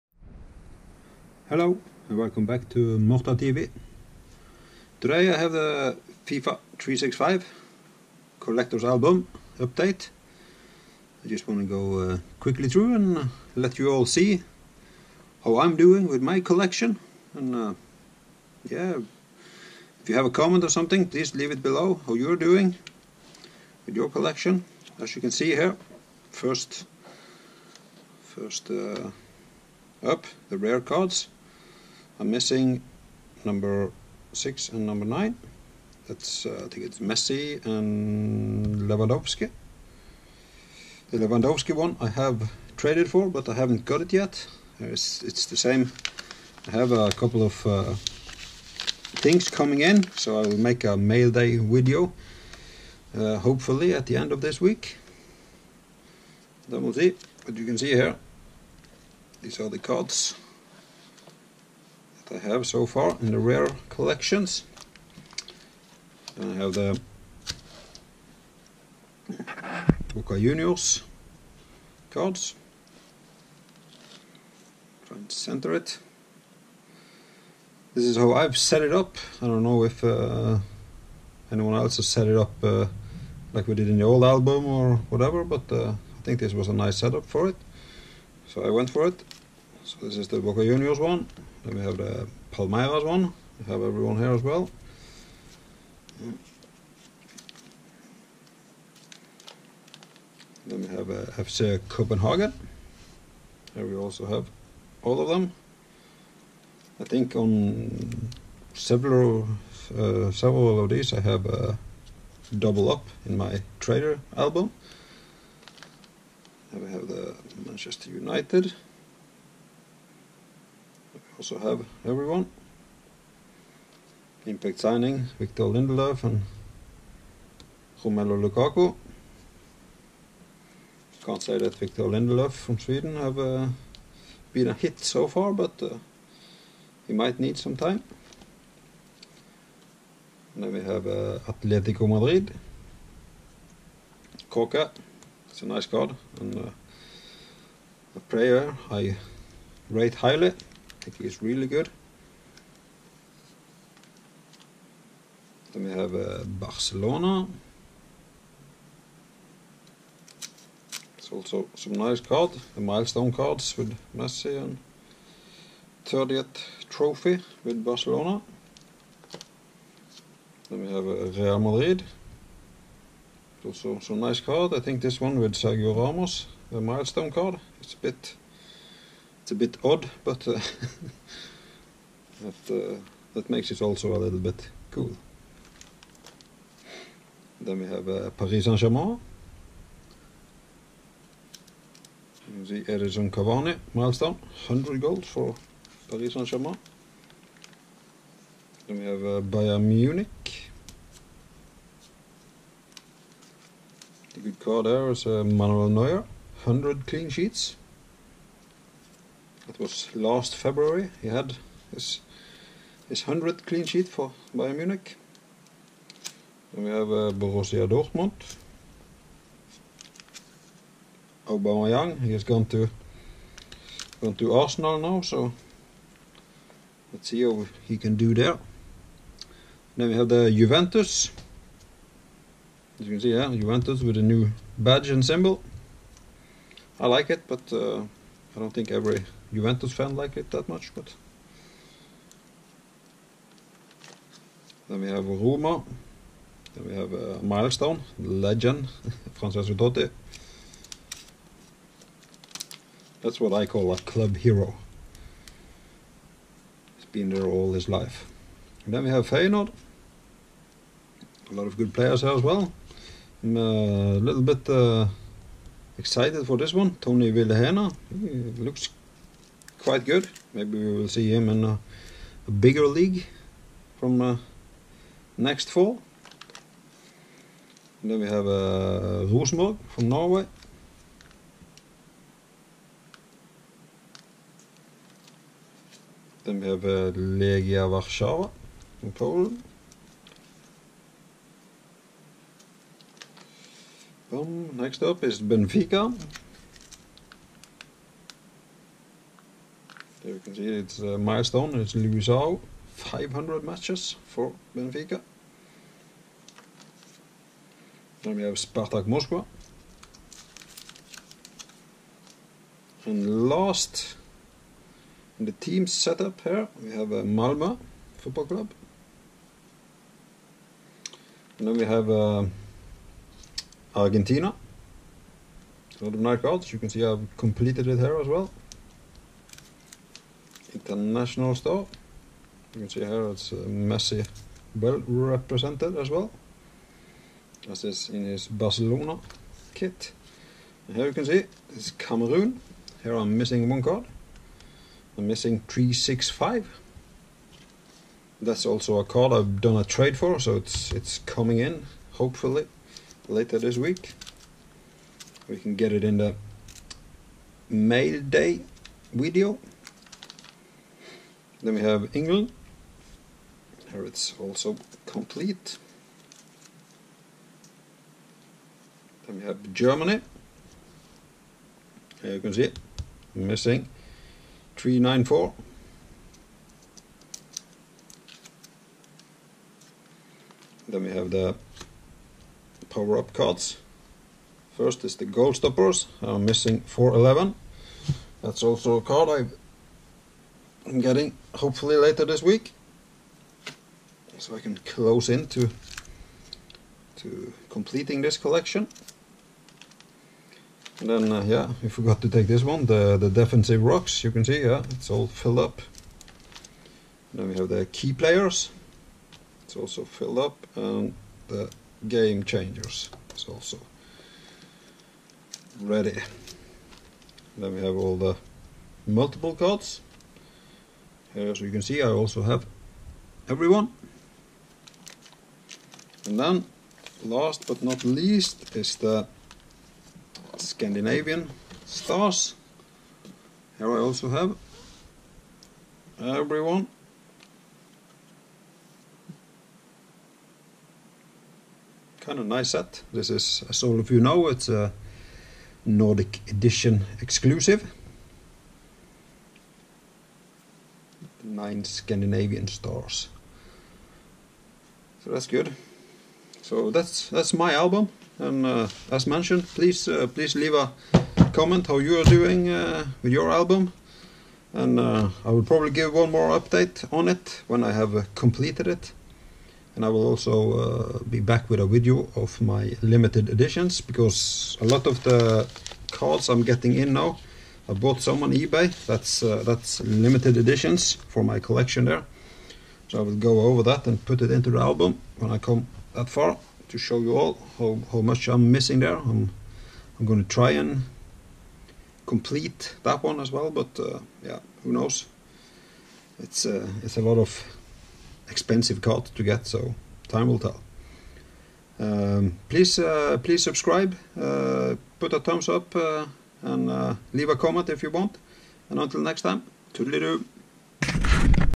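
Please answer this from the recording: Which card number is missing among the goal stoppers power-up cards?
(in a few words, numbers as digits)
411.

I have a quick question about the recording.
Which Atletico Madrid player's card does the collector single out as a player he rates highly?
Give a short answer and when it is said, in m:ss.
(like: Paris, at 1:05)
Koke, at 2:24.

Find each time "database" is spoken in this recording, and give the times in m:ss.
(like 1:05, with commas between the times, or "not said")
not said.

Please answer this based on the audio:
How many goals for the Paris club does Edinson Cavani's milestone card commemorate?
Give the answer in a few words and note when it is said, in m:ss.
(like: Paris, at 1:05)
100, at 3:14.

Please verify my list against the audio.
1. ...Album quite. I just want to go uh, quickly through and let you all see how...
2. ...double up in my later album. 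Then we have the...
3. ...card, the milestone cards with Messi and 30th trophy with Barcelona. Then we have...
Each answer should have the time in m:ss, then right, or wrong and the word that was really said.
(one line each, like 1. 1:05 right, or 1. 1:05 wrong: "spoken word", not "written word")
1. 0:08 wrong: "update", not "quite"
2. 1:52 wrong: "trader", not "later"
3. 2:42 right.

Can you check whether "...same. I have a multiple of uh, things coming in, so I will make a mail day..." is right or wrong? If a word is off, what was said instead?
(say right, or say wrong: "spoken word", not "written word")
wrong: "couple", not "multiple".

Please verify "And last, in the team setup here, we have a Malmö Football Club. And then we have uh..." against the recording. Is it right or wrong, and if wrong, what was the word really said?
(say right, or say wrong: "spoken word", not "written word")
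right.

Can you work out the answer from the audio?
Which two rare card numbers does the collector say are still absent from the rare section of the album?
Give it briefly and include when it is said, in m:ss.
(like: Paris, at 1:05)
6 and 9, at 0:33.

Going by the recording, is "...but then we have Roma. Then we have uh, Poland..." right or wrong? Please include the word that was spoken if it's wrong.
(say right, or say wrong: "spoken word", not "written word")
wrong: "Milestone", not "Poland".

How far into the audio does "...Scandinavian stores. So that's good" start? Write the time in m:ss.
7:31.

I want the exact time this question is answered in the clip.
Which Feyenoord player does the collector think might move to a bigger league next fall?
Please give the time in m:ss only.
4:27.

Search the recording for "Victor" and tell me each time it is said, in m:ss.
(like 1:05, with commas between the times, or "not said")
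2:05, 2:11.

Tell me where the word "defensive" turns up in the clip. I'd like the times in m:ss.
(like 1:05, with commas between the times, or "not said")
6:43.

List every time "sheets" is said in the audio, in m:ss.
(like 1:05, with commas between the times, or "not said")
3:27, 3:33.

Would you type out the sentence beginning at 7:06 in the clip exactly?
And then last but not least is the Scandinavian stars.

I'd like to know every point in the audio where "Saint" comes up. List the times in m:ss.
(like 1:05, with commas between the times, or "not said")
3:08, 3:16.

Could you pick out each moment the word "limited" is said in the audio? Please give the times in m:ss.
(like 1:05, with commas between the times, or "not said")
7:53, 7:59.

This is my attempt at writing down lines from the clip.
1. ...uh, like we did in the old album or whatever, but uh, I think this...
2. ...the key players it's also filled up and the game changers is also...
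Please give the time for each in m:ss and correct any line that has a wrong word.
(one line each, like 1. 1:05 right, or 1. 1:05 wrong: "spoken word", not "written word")
1. 1:22 right
2. 6:47 right.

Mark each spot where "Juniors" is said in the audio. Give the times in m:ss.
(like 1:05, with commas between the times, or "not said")
1:10, 1:30.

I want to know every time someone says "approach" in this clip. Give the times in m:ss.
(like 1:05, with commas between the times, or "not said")
not said.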